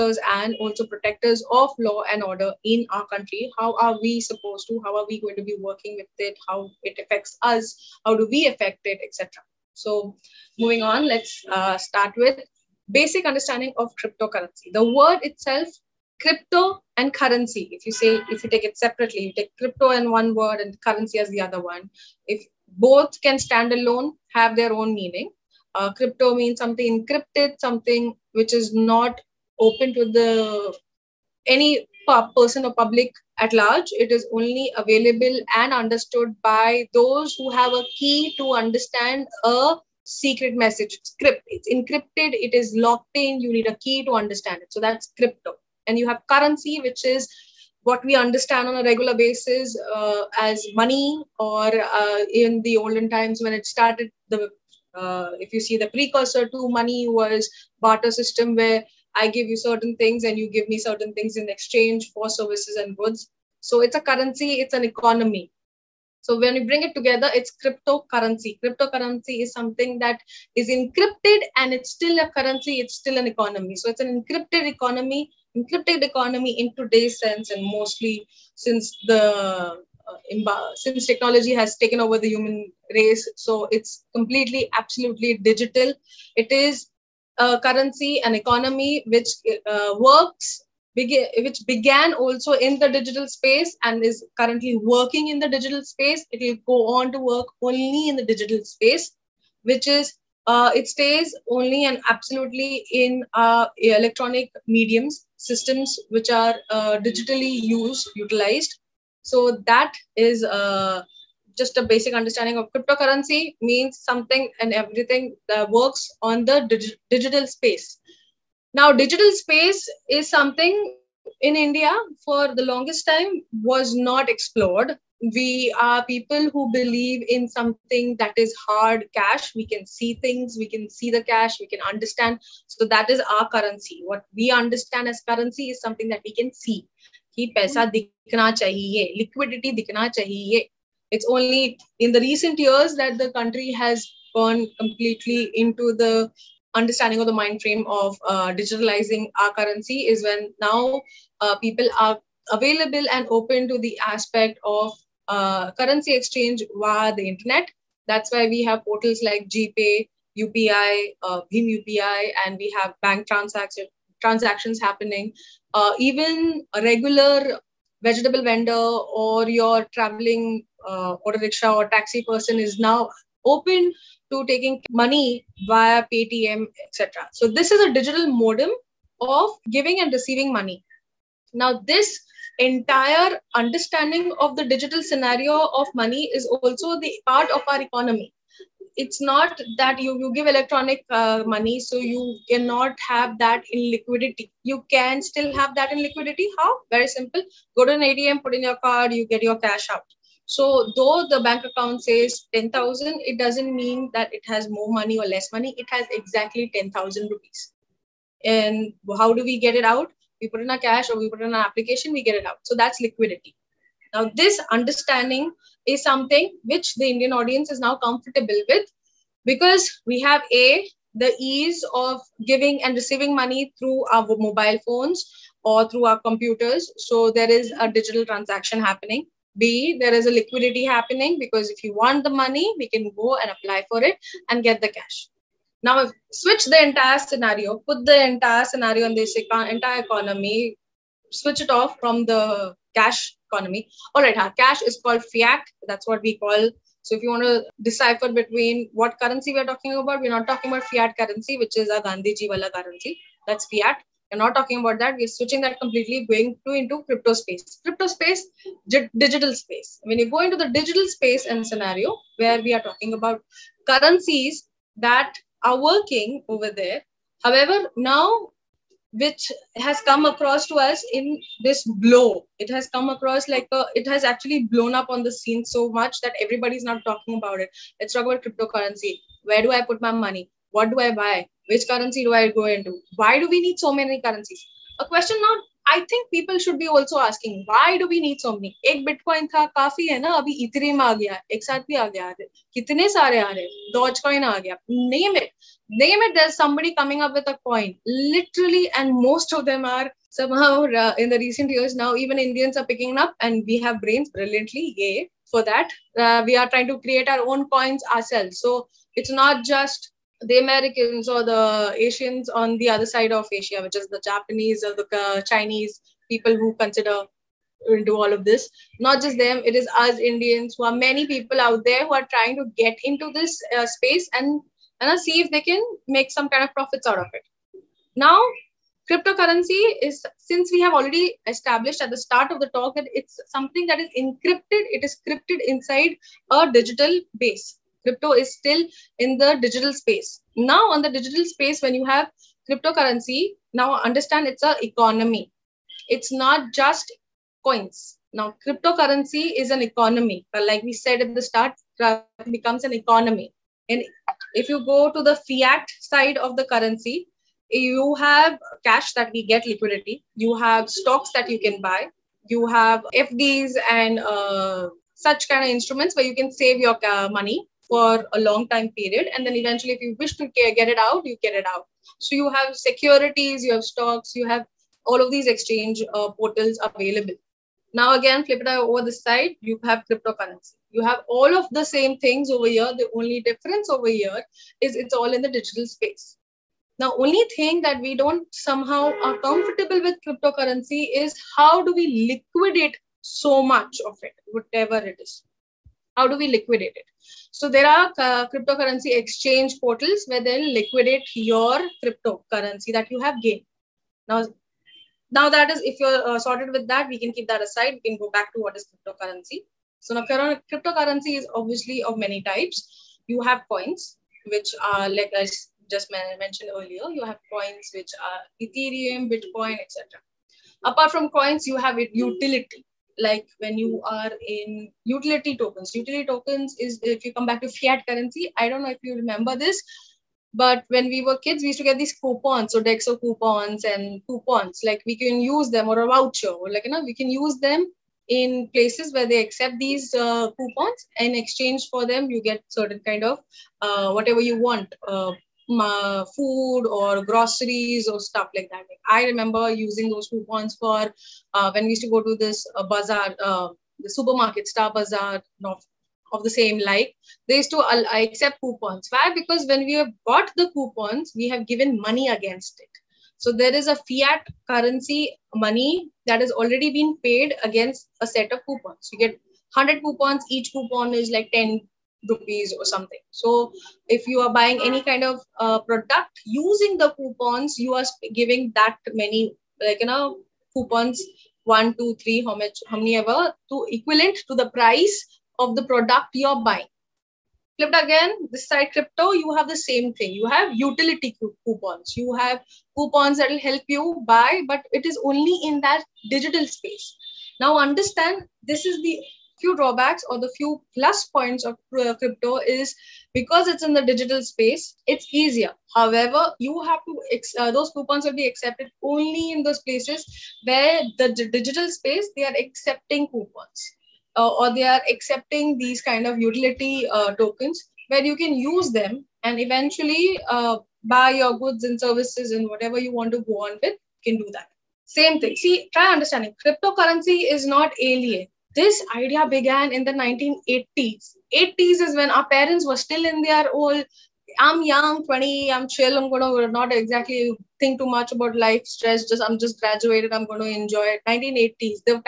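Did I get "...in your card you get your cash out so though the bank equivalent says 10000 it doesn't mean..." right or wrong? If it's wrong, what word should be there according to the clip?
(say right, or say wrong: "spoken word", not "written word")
wrong: "account", not "equivalent".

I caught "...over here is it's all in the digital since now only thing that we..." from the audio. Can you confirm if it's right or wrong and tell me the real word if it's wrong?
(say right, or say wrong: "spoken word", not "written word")
wrong: "space", not "since".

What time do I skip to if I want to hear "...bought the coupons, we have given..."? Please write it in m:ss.
7:40.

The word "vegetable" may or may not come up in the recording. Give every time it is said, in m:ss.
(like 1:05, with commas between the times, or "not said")
2:48.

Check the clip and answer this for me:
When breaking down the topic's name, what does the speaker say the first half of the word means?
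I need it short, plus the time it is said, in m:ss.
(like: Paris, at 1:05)
Something encrypted, at 0:25.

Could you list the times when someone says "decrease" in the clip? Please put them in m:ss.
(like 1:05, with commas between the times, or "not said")
not said.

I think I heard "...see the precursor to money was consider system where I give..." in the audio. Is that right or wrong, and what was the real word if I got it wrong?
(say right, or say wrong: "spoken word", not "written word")
wrong: "barter", not "consider".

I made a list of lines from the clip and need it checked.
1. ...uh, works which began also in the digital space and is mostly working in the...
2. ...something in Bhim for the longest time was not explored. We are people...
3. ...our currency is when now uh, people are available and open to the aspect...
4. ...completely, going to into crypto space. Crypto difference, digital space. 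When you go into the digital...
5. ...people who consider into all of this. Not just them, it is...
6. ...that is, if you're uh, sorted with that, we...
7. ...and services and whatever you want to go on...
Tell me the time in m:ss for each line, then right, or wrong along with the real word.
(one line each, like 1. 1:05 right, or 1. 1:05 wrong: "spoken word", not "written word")
1. 1:29 wrong: "currently", not "mostly"
2. 2:00 wrong: "India", not "Bhim"
3. 2:29 right
4. 4:15 wrong: "space", not "difference"
5. 5:16 right
6. 6:45 right
7. 8:41 right.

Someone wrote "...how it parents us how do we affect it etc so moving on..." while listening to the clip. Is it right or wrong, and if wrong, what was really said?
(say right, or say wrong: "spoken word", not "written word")
wrong: "affects", not "parents".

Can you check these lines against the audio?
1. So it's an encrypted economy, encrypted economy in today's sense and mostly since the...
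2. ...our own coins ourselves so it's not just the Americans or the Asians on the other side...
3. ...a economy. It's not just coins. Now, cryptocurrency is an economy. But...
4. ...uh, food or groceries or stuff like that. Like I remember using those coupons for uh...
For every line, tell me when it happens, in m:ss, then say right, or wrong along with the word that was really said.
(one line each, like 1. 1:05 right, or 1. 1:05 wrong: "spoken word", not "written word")
1. 1:13 right
2. 5:07 right
3. 5:44 right
4. 7:25 right.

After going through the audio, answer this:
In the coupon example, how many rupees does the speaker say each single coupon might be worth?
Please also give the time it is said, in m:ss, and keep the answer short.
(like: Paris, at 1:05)
10 rupees, at 7:51.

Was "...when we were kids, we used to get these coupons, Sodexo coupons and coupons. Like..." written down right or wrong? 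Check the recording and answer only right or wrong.
right.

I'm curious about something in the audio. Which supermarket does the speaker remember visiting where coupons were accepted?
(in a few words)
Star Bazaar.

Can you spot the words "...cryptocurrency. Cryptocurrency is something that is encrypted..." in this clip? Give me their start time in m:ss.
1:07.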